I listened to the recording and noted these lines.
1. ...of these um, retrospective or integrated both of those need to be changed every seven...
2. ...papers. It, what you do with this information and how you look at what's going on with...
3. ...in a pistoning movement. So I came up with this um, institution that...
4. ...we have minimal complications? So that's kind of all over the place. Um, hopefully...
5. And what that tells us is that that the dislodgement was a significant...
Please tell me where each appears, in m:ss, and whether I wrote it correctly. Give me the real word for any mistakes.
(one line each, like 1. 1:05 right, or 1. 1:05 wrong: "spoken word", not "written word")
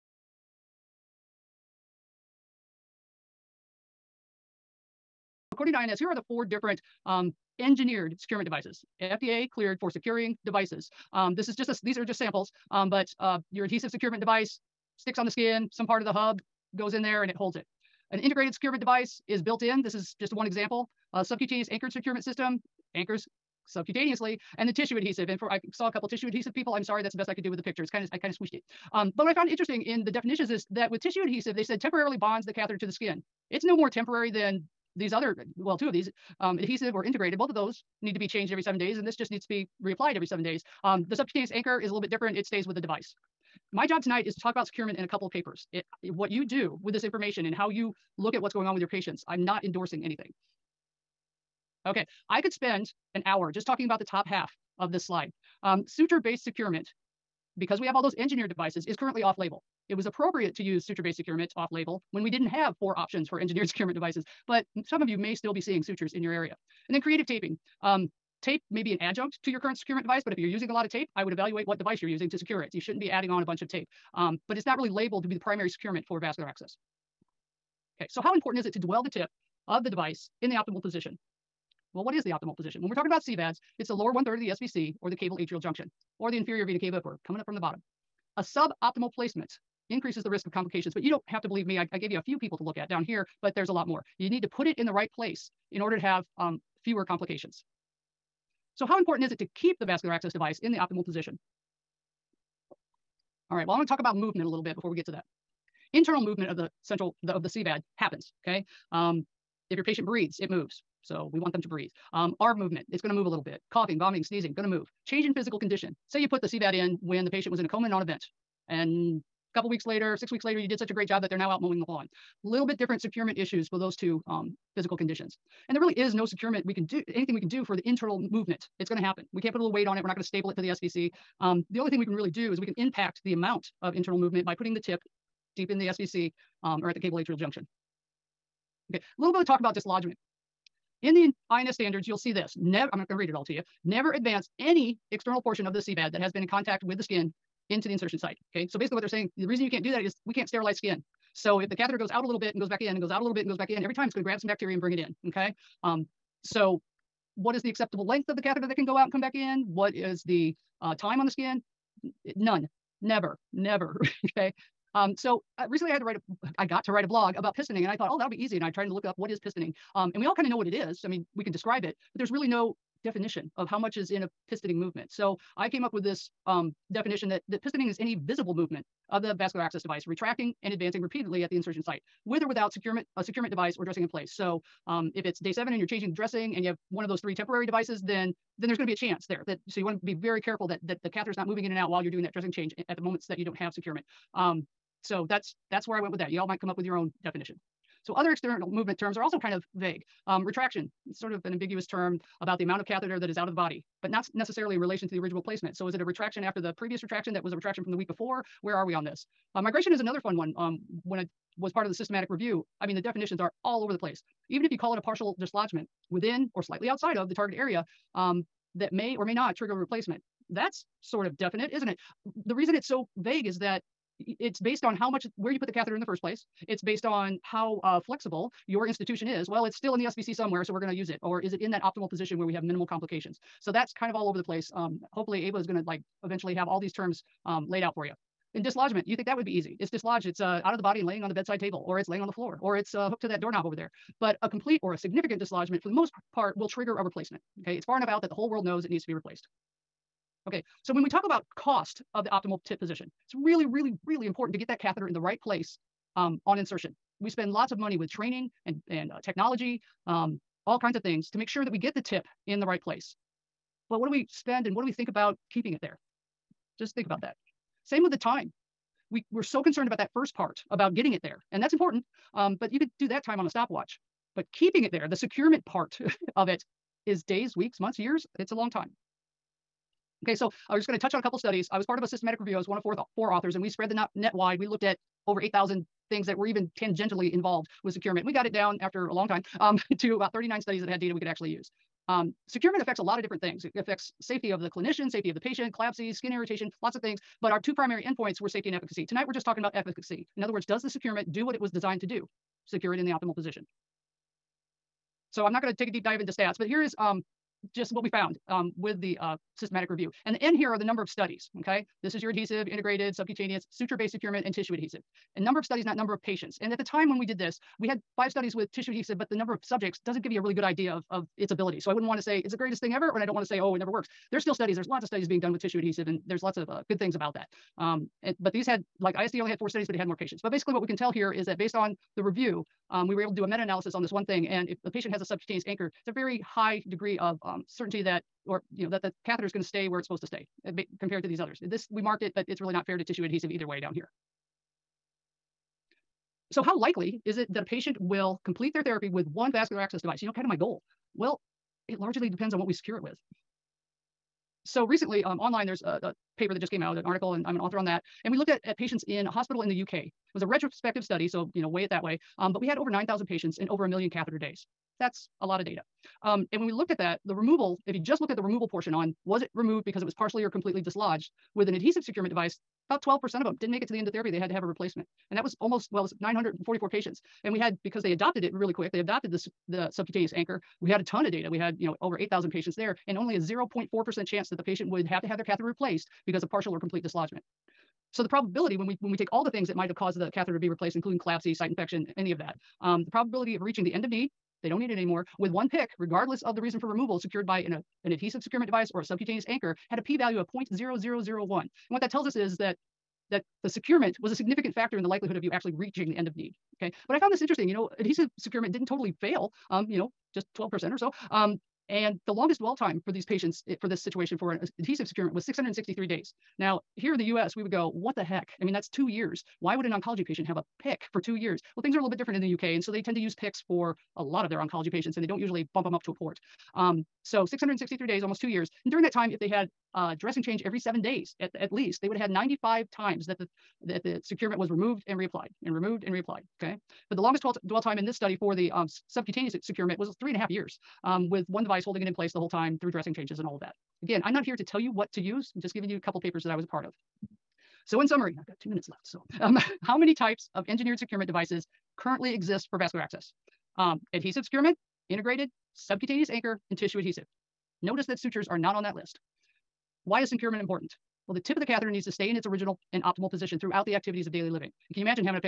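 1. 0:35 wrong: "adhesive", not "retrospective"
2. 0:45 right
3. 2:54 wrong: "definition", not "institution"
4. 3:52 right
5. 6:41 wrong: "securement", not "dislodgement".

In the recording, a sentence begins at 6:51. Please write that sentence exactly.
Um, and the longest dwell time for these patients it, eh, for this situation for an adhesive securement was 663 days.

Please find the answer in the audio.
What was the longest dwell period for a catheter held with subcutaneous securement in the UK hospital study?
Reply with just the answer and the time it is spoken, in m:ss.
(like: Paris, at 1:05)
3.5 years, at 7:20.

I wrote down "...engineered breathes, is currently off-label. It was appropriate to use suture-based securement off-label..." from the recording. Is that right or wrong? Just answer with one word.
wrong.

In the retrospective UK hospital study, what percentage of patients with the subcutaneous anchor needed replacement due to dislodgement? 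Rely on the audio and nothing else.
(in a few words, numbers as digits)
0.4%.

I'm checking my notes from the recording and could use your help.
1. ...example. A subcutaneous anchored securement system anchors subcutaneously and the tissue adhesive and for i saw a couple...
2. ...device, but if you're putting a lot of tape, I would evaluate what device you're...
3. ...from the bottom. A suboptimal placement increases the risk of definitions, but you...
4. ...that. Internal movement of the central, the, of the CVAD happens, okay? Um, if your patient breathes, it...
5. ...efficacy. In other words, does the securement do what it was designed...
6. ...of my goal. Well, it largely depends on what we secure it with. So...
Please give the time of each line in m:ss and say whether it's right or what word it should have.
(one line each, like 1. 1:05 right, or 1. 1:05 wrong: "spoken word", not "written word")
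1. 0:20 right
2. 1:10 wrong: "using", not "putting"
3. 1:27 wrong: "complications", not "definitions"
4. 1:45 right
5. 4:59 right
6. 5:50 right.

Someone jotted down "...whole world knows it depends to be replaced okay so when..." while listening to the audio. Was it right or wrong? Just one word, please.
wrong.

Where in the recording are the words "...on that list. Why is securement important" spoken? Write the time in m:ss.
7:38.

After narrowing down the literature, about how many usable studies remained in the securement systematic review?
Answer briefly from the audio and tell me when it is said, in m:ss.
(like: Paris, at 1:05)
39, at 4:50.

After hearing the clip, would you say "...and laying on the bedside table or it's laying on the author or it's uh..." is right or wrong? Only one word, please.
wrong.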